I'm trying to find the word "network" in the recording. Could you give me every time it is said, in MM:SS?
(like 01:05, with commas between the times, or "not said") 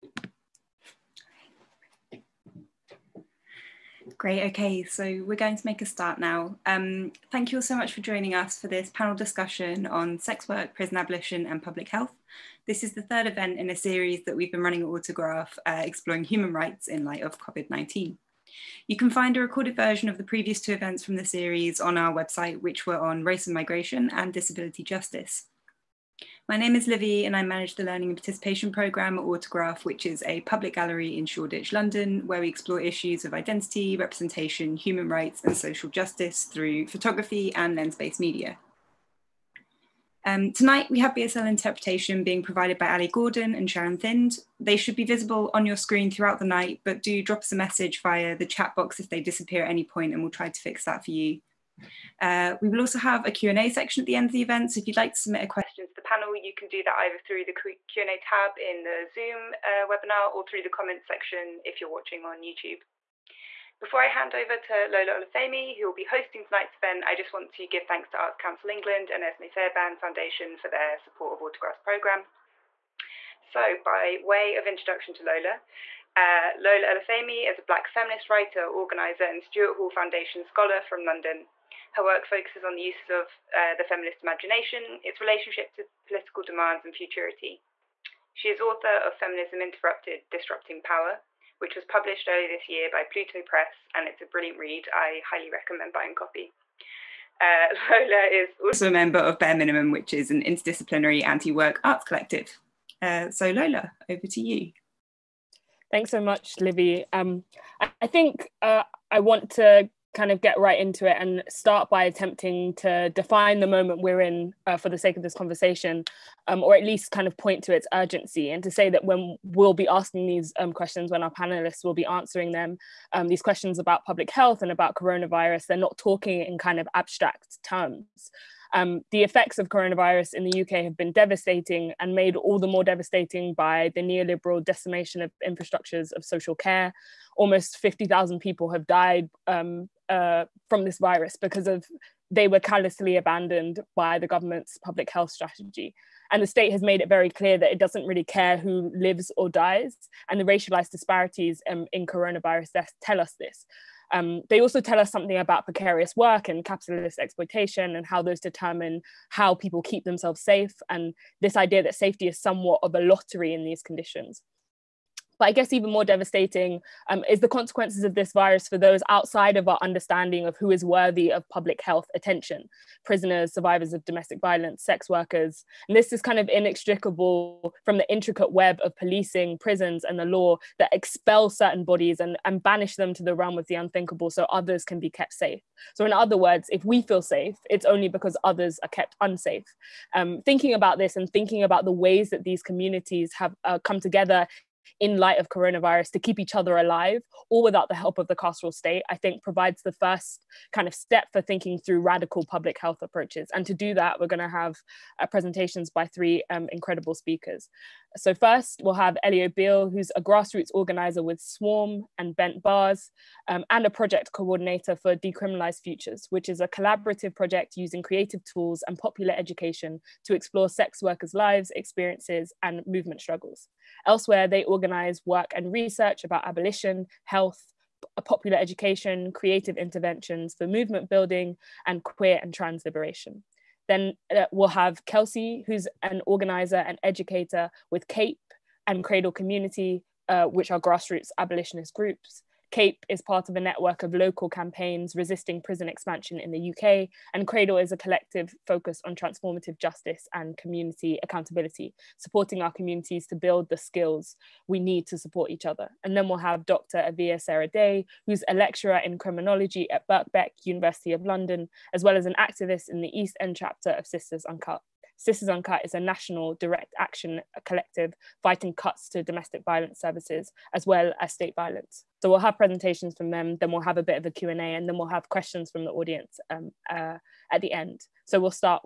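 04:03.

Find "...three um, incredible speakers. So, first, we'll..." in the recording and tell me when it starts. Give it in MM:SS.
03:26.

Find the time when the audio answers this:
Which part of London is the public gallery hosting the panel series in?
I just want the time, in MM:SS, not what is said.
00:31.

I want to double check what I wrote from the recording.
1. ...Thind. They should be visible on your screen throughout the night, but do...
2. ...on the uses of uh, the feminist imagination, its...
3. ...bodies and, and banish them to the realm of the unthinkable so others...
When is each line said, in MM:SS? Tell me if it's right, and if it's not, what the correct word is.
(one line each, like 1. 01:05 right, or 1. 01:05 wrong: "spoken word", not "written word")
1. 00:43 right
2. 01:22 right
3. 03:01 right.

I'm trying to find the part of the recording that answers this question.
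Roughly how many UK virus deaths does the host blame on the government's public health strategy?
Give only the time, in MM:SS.
02:17.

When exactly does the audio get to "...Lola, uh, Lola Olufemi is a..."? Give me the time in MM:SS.
01:15.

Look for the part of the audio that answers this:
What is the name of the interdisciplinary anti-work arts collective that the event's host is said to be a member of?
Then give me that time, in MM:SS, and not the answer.
01:39.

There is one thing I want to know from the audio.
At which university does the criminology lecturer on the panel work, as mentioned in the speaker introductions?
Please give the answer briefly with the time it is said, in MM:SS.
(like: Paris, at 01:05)
Birkbeck, at 04:20.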